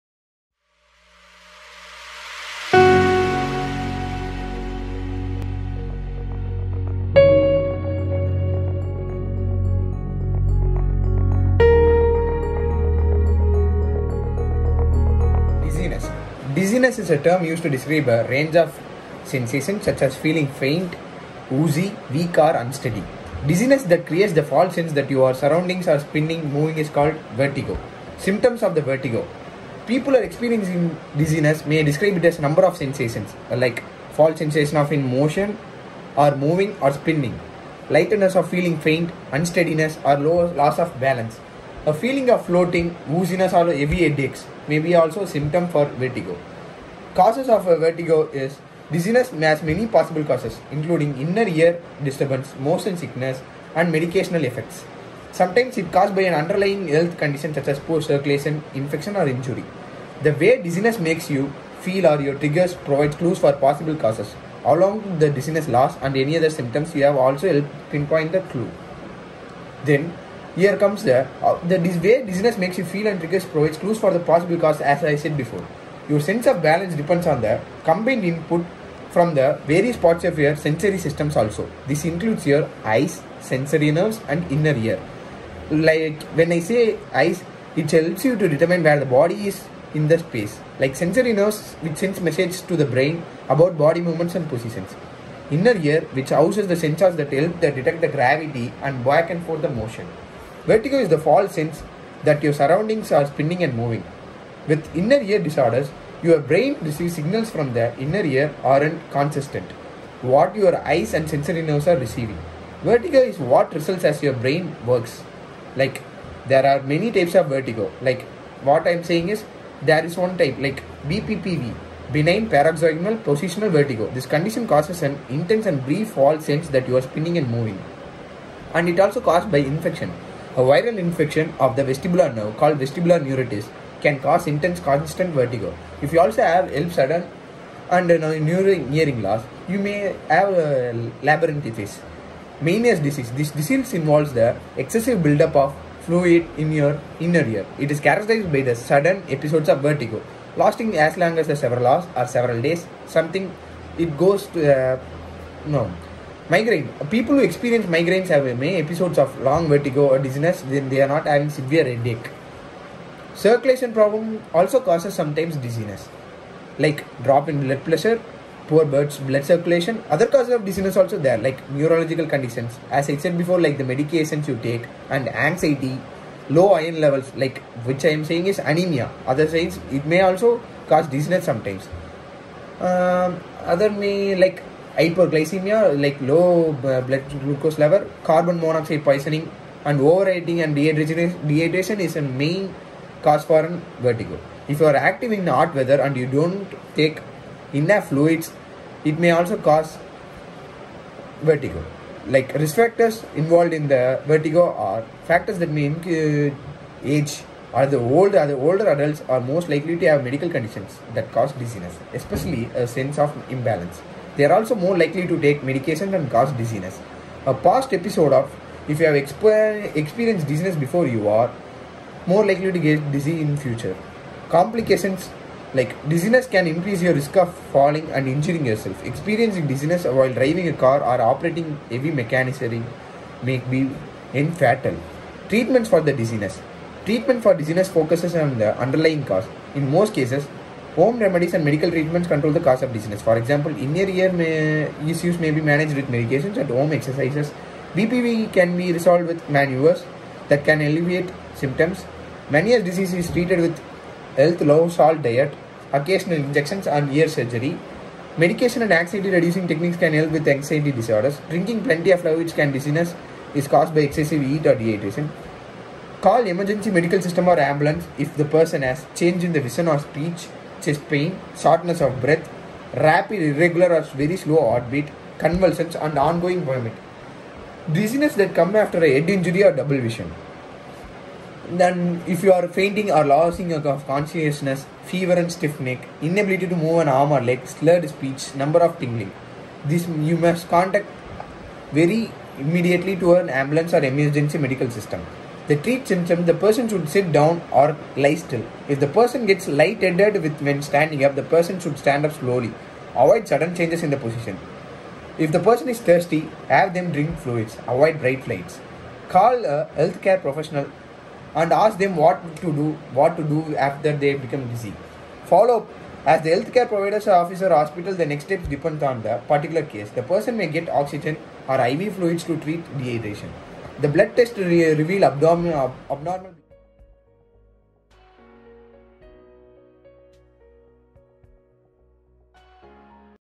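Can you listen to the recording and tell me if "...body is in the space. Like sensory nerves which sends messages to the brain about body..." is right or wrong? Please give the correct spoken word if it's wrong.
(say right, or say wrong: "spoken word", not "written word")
right.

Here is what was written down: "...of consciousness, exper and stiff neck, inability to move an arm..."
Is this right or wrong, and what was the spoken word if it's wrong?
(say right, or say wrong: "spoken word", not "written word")
wrong: "fever", not "exper".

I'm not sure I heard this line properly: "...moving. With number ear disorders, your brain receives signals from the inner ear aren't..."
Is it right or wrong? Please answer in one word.
wrong.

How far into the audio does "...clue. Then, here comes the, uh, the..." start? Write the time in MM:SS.
01:08.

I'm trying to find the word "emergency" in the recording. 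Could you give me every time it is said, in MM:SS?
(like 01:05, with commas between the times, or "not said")
04:26, 04:54.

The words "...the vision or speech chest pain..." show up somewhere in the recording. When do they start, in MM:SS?
04:29.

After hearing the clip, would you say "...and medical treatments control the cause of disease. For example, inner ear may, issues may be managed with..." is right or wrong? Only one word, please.
right.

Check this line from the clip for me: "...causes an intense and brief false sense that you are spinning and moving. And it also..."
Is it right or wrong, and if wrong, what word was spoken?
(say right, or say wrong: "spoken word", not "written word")
right.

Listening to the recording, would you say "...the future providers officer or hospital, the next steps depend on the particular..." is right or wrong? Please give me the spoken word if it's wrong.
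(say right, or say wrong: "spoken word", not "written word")
wrong: "healthcare", not "future".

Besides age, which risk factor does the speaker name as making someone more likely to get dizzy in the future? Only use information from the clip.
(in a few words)
a past episode.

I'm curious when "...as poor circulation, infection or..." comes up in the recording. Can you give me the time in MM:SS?
00:57.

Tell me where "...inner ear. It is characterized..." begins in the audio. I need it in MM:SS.
02:27.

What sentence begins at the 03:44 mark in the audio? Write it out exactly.
Complications like dizziness can increase your risk of falling and injuring yourself.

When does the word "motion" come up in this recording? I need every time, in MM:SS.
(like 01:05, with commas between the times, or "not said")
00:35, 00:52, 01:39.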